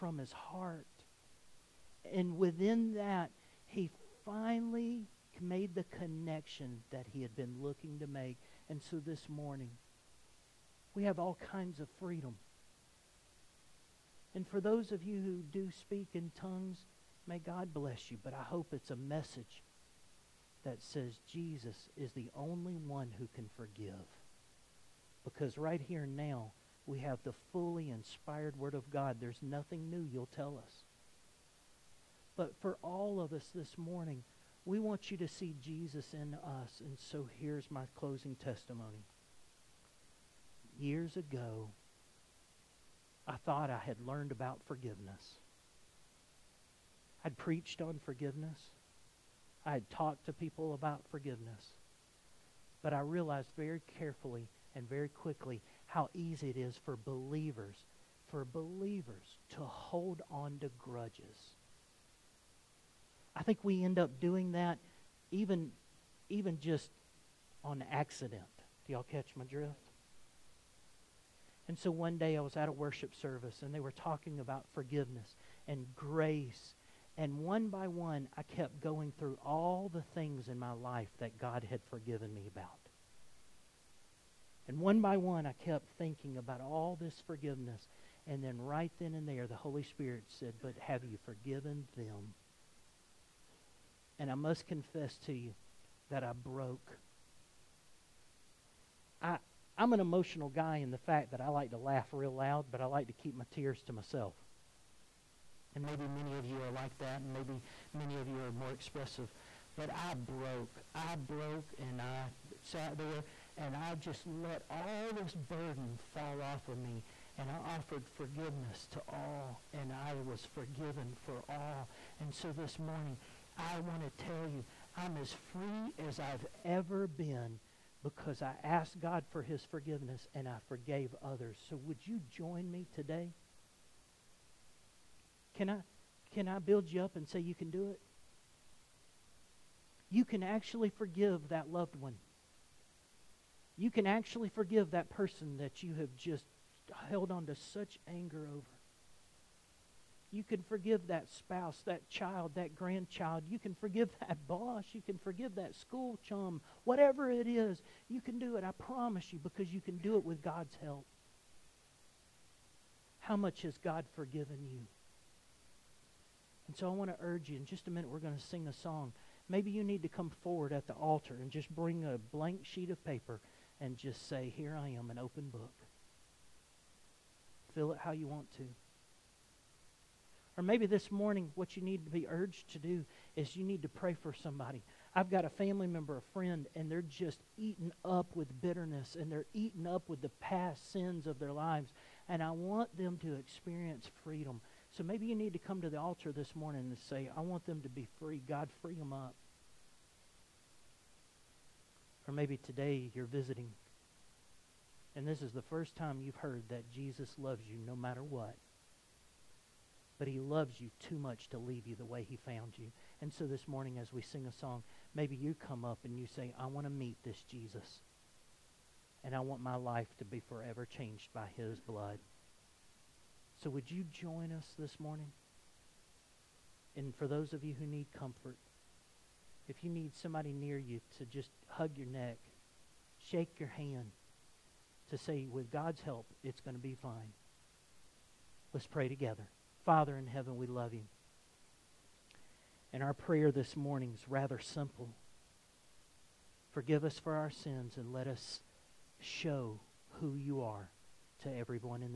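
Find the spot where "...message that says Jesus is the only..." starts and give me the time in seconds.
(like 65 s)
18 s.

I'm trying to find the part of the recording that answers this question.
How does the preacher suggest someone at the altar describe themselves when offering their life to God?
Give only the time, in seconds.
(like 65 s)
175 s.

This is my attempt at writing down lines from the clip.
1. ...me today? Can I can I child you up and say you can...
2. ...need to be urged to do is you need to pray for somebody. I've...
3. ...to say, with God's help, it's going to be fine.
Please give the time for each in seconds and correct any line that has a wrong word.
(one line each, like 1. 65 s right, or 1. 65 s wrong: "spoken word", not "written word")
1. 132 s wrong: "build", not "child"
2. 181 s right
3. 235 s right.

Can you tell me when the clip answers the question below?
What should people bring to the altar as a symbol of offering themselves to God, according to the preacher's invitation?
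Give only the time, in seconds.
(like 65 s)
172 s.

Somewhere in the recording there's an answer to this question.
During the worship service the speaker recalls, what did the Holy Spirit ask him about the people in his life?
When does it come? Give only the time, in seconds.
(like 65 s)
90 s.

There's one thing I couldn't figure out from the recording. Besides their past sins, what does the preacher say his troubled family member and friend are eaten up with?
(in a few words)
Bitterness.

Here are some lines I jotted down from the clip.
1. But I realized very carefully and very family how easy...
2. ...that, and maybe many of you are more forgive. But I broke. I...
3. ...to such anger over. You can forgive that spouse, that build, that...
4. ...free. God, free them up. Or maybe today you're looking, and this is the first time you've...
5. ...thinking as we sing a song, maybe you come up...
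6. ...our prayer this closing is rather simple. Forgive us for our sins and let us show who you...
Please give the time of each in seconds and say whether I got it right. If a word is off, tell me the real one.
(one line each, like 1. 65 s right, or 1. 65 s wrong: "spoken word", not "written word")
1. 52 s wrong: "quickly", not "family"
2. 106 s wrong: "expressive", not "forgive"
3. 147 s wrong: "child", not "build"
4. 198 s wrong: "visiting", not "looking"
5. 213 s wrong: "morning", not "thinking"
6. 243 s wrong: "morning", not "closing".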